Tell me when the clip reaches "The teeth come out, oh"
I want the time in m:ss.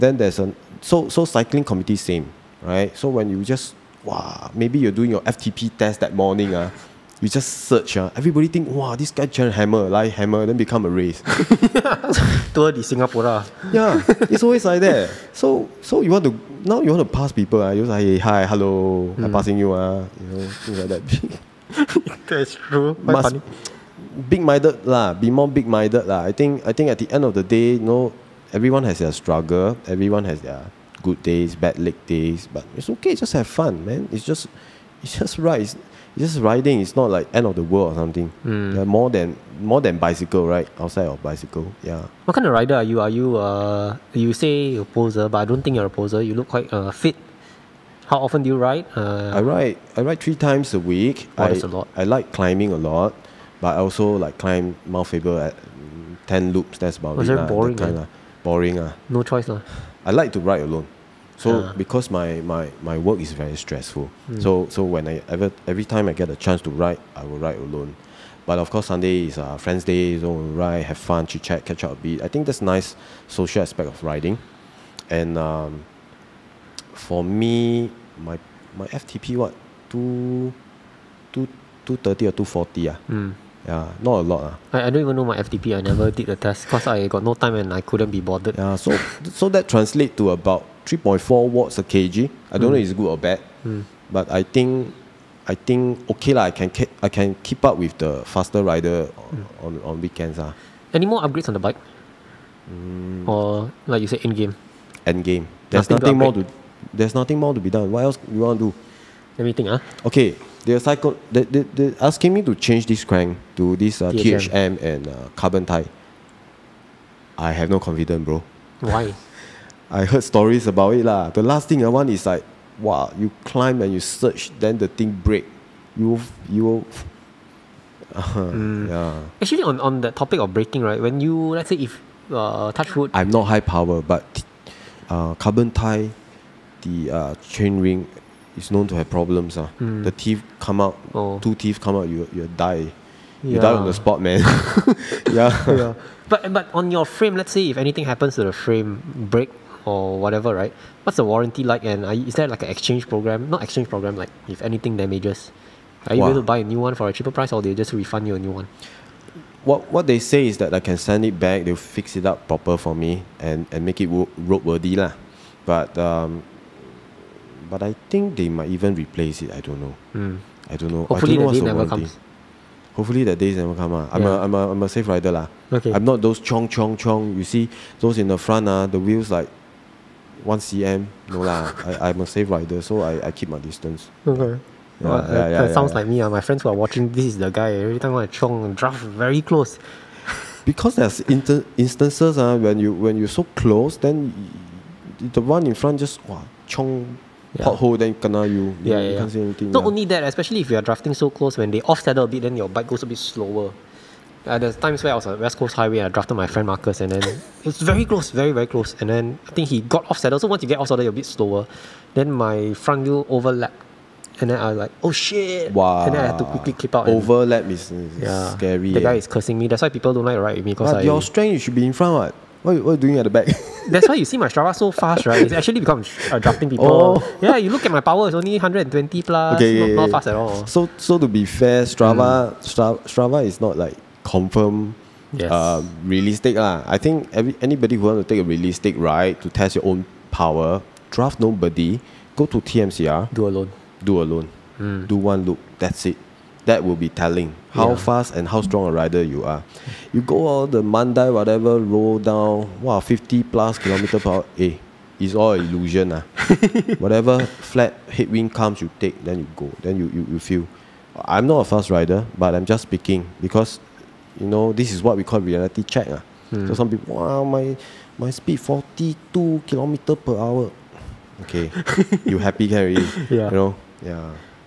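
2:20.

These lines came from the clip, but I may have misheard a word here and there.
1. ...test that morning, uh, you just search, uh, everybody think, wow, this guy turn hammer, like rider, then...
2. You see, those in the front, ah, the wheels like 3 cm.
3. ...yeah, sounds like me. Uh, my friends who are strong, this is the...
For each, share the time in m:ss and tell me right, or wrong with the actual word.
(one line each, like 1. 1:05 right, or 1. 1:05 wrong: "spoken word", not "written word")
1. 0:05 wrong: "hammer", not "rider"
2. 2:57 wrong: "1", not "3"
3. 3:05 wrong: "watching", not "strong".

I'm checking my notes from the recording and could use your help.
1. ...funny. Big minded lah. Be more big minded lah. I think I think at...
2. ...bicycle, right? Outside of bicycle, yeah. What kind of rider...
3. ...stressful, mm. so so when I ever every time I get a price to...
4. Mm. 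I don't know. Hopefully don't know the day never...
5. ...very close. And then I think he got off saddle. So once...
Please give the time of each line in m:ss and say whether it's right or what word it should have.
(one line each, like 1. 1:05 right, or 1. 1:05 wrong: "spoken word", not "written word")
1. 0:23 right
2. 0:39 right
3. 1:03 wrong: "chance", not "price"
4. 2:50 right
5. 3:28 right.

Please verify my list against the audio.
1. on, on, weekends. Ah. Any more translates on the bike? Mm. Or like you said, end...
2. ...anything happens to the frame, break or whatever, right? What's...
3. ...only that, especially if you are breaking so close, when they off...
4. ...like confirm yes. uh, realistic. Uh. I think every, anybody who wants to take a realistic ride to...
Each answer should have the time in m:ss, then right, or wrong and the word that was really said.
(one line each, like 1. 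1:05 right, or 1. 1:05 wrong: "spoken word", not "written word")
1. 1:39 wrong: "upgrades", not "translates"
2. 2:27 right
3. 3:19 wrong: "drafting", not "breaking"
4. 3:53 right.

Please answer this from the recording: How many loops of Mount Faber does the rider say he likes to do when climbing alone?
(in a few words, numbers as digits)
10.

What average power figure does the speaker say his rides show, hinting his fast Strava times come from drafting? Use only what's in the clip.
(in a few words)
120 plus.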